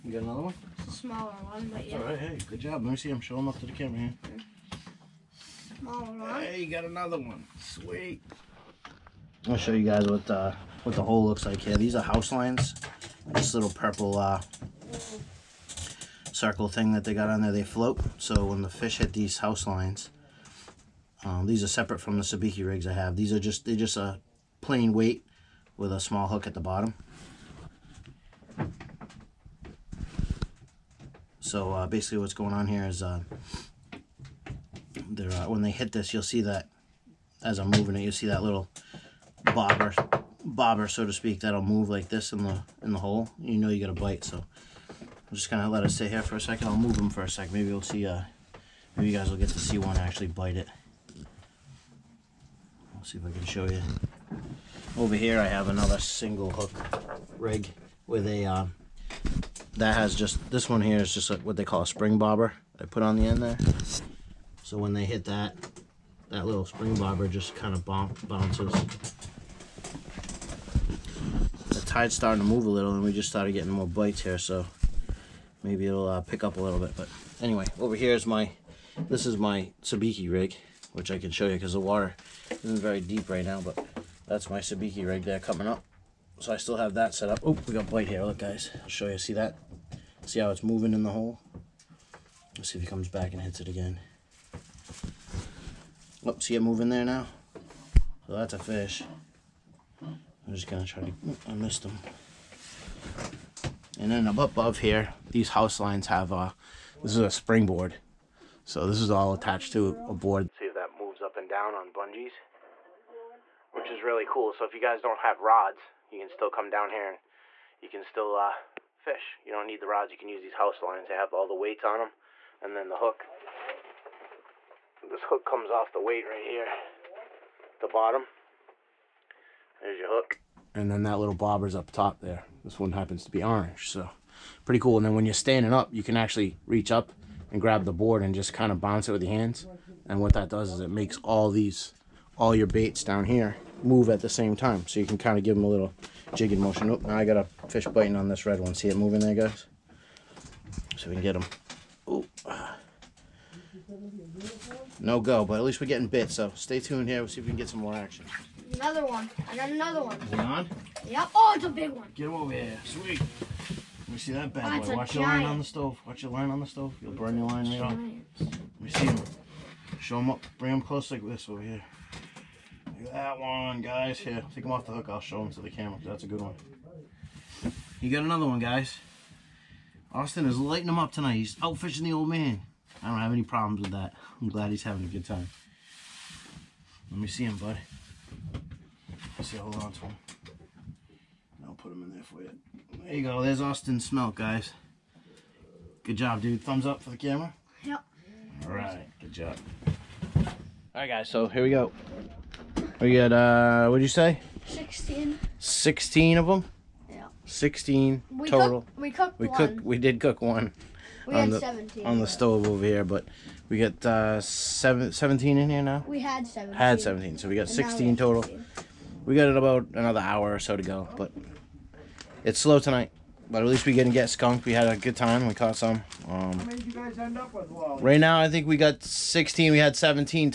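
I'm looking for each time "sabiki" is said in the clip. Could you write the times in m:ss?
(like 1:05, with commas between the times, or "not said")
0:22, 1:19, 1:24.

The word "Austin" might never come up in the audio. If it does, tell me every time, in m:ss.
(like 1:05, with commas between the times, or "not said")
3:00, 3:13.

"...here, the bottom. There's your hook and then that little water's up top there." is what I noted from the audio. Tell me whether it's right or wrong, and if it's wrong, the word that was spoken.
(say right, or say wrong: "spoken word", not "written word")
wrong: "bobber", not "water".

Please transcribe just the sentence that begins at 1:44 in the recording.
And then up above here, these house lines have a, this is a springboard.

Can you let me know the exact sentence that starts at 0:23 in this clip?
These are just, they're just a plain weight with a small hook at the bottom.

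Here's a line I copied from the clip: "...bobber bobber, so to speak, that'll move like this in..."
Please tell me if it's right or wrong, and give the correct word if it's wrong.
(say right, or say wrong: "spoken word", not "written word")
right.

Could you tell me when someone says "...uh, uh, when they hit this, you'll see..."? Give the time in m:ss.
0:33.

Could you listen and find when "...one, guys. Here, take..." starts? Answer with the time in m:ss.
2:53.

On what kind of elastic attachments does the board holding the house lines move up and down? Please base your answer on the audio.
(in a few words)
bungees.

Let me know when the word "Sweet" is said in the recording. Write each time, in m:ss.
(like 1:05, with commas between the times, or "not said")
0:07, 2:42.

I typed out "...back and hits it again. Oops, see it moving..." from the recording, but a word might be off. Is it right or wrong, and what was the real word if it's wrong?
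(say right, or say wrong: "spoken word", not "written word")
right.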